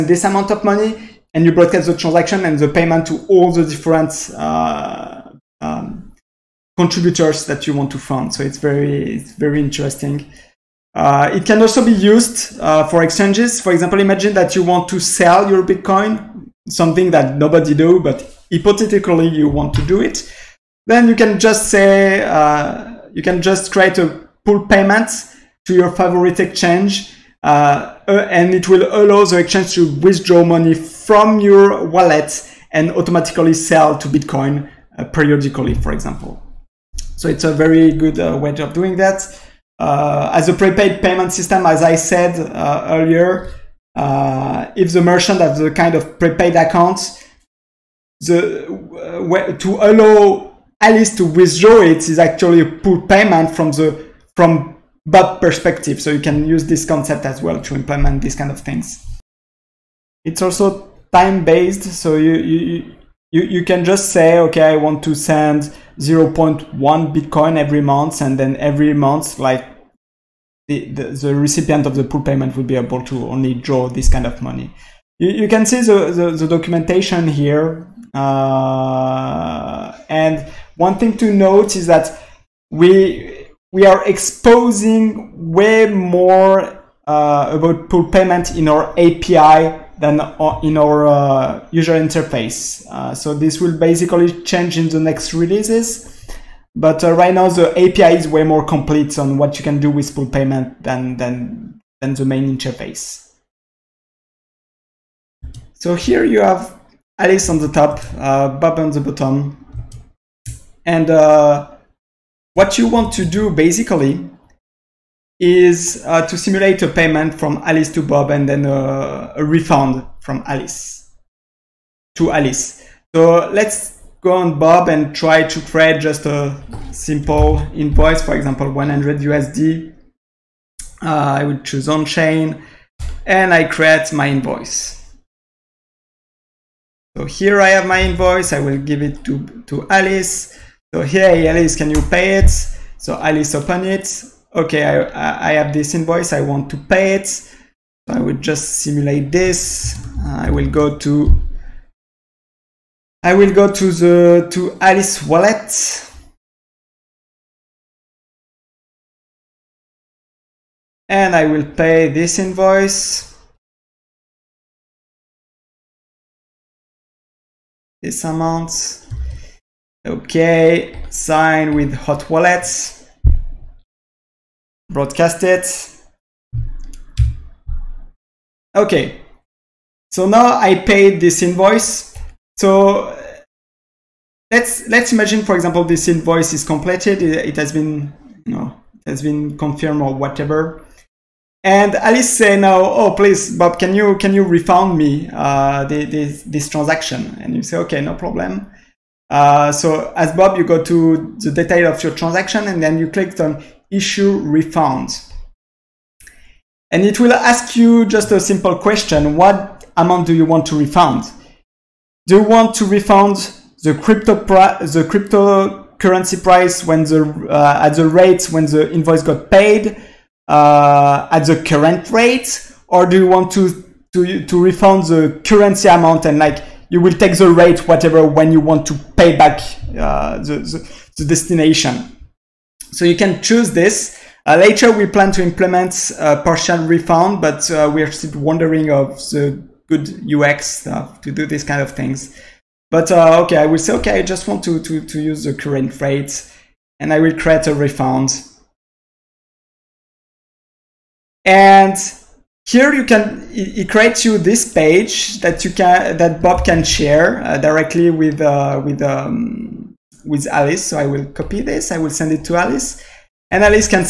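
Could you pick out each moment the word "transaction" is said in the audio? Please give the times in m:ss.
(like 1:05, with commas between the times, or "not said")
0:01, 3:16, 3:22.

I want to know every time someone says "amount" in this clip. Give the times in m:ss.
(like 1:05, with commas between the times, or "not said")
0:00, 2:48, 3:29, 3:45.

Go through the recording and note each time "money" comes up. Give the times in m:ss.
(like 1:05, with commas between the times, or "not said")
0:00, 0:30, 1:14.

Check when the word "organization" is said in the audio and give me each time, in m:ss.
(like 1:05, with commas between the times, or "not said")
not said.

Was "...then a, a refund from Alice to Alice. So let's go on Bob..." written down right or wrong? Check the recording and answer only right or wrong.
right.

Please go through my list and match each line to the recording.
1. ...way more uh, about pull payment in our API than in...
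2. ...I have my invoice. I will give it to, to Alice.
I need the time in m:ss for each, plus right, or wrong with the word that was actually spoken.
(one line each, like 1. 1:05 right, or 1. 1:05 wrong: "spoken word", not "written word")
1. 1:25 right
2. 2:17 right.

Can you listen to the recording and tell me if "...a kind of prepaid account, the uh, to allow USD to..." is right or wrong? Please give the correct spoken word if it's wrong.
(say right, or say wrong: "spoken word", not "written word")
wrong: "Alice", not "USD".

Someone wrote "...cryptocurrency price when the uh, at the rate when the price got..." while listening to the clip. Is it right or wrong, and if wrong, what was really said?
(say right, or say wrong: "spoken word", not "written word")
wrong: "invoice", not "price".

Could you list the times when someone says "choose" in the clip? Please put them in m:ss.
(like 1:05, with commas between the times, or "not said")
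2:11, 3:53.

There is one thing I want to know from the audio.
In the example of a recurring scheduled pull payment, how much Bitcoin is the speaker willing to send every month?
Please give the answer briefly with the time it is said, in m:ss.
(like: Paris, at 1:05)
0.1 Bitcoin, at 1:05.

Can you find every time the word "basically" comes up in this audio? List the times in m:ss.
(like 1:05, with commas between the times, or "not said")
1:33, 1:53.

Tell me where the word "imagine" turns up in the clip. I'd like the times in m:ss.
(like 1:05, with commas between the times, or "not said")
0:13, 3:05.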